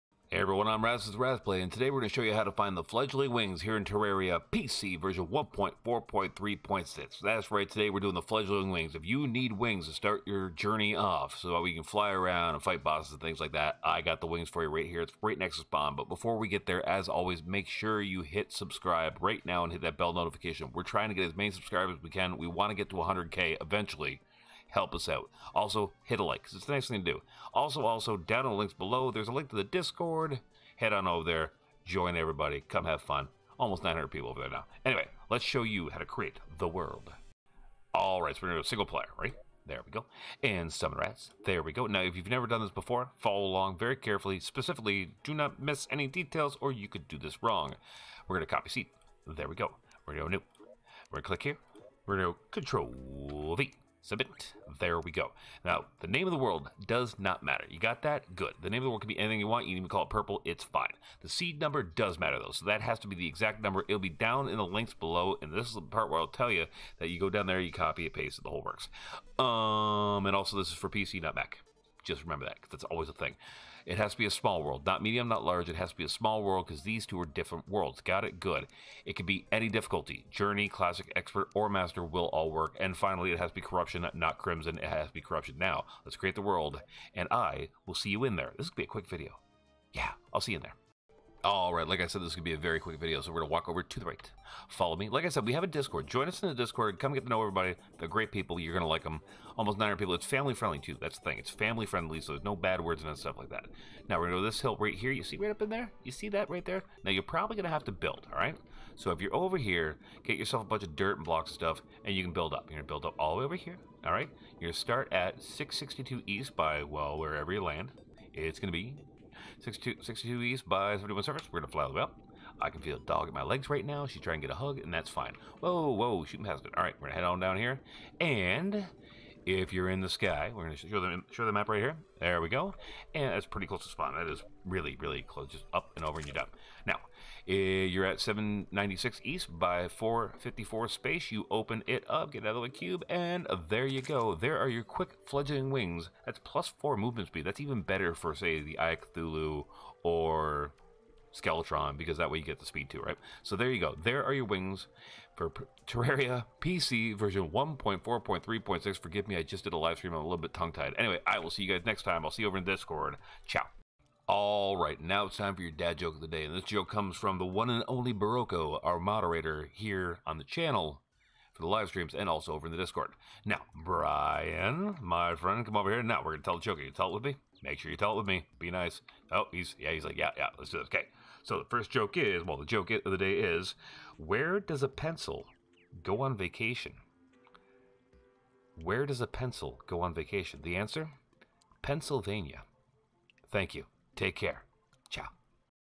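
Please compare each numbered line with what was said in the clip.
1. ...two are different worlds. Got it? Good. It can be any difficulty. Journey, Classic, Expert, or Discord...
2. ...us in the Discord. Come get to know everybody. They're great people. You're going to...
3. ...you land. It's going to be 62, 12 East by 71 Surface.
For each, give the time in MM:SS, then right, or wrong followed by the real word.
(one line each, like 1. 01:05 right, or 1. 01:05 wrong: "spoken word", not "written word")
1. 01:17 wrong: "Master", not "Discord"
2. 01:36 right
3. 01:57 wrong: "62", not "12".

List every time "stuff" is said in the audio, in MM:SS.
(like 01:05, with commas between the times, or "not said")
01:43, 01:51.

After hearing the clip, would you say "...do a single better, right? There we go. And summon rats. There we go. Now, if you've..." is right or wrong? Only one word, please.
wrong.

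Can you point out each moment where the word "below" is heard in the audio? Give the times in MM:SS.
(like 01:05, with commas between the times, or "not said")
00:28, 01:04.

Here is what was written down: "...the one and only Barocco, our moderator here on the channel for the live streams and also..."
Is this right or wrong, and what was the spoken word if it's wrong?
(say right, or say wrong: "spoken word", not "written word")
right.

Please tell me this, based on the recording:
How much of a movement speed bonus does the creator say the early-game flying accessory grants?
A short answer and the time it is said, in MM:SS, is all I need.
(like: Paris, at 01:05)
plus 4, at 02:26.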